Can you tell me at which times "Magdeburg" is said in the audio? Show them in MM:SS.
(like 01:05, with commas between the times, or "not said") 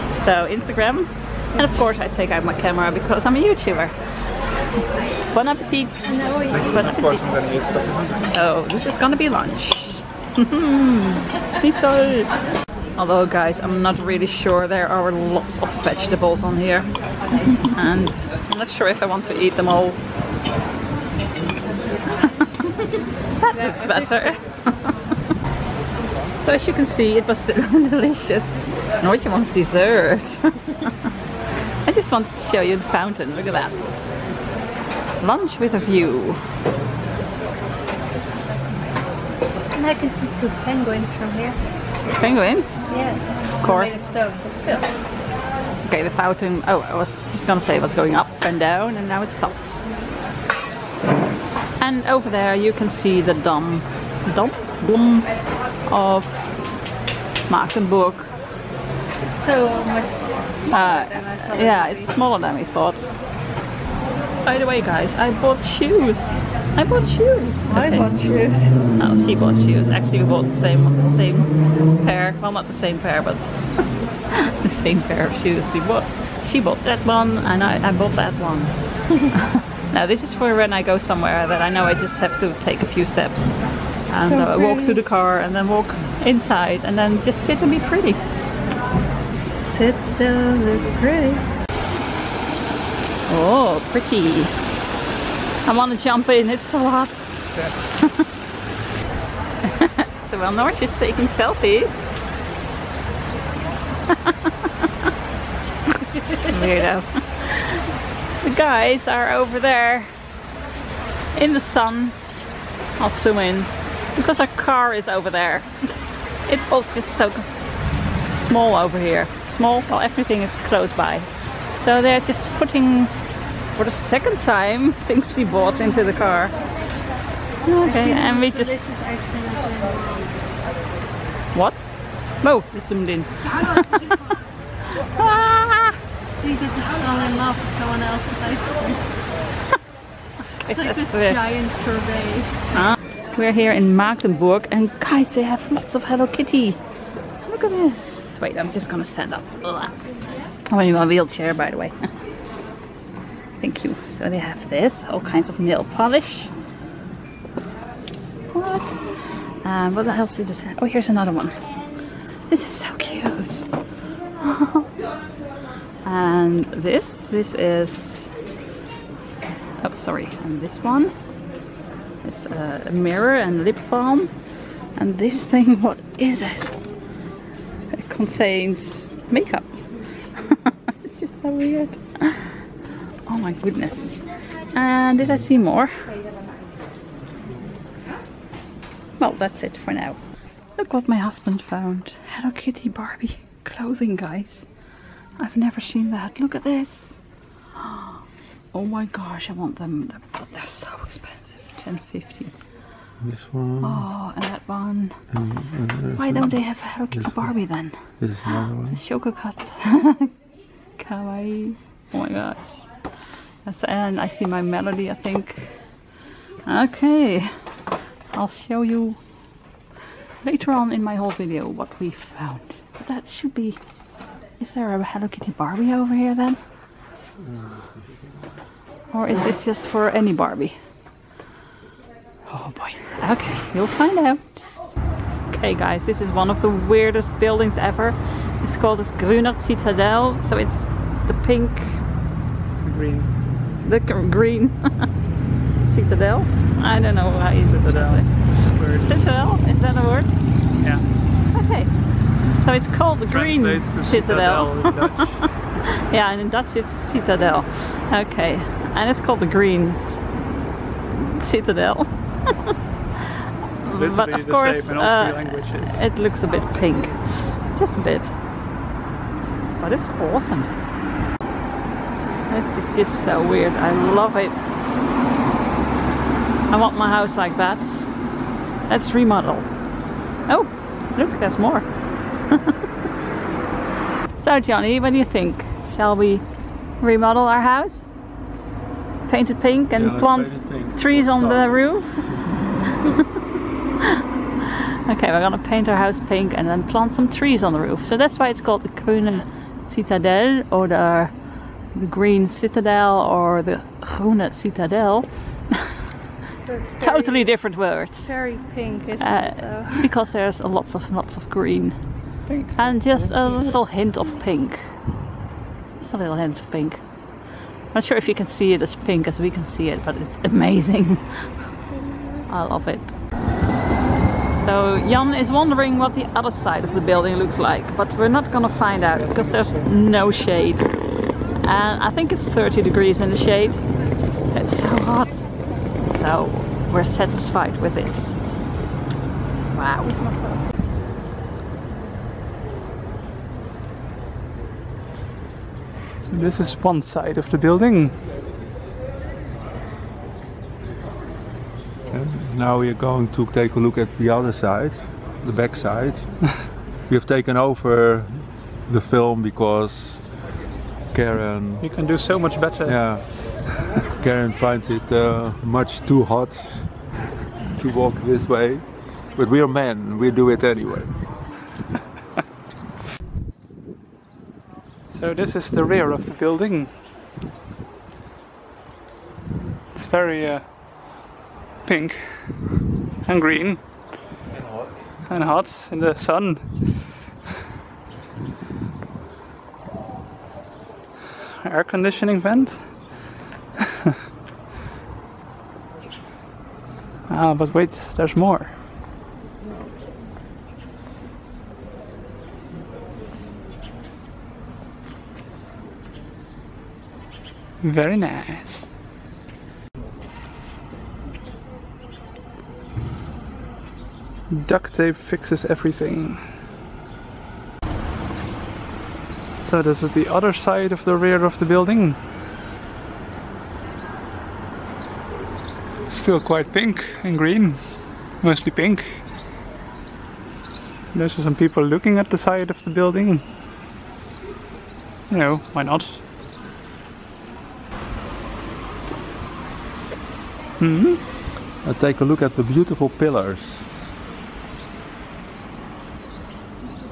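00:57, 02:23.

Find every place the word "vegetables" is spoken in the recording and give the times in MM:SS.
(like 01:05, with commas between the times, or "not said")
00:15.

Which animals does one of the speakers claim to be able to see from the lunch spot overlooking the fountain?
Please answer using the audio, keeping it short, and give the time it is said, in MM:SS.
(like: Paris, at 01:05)
Two penguins, at 00:40.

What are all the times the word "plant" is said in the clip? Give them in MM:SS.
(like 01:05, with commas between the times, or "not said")
04:50, 04:56.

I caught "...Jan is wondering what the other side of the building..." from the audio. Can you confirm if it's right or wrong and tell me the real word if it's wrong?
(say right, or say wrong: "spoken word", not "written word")
right.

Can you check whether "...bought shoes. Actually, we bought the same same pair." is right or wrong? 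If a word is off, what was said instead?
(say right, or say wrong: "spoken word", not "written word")
right.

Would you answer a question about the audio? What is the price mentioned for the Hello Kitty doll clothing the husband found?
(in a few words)
10.50.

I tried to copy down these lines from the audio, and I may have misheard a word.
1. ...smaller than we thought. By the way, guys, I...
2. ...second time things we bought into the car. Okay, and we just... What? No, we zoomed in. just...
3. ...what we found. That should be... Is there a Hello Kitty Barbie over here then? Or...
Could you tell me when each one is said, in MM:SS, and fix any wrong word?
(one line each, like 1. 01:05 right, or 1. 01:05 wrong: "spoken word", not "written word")
1. 01:02 right
2. 02:03 right
3. 03:41 right.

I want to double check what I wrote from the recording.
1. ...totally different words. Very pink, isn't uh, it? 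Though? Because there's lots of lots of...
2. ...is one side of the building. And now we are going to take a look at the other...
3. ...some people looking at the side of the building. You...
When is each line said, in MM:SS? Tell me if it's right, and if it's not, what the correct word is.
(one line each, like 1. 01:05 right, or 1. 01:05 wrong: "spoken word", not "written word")
1. 05:07 right
2. 05:46 right
3. 07:11 right.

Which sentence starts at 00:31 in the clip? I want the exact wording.
I just wanted to show you the fountain.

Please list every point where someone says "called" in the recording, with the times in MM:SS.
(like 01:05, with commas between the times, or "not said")
03:58, 04:12, 04:19, 04:58.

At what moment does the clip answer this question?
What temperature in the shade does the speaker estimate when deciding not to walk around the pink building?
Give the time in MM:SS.
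05:32.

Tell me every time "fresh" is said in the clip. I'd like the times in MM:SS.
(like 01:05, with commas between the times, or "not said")
not said.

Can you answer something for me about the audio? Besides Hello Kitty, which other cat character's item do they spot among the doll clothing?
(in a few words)
Chococat.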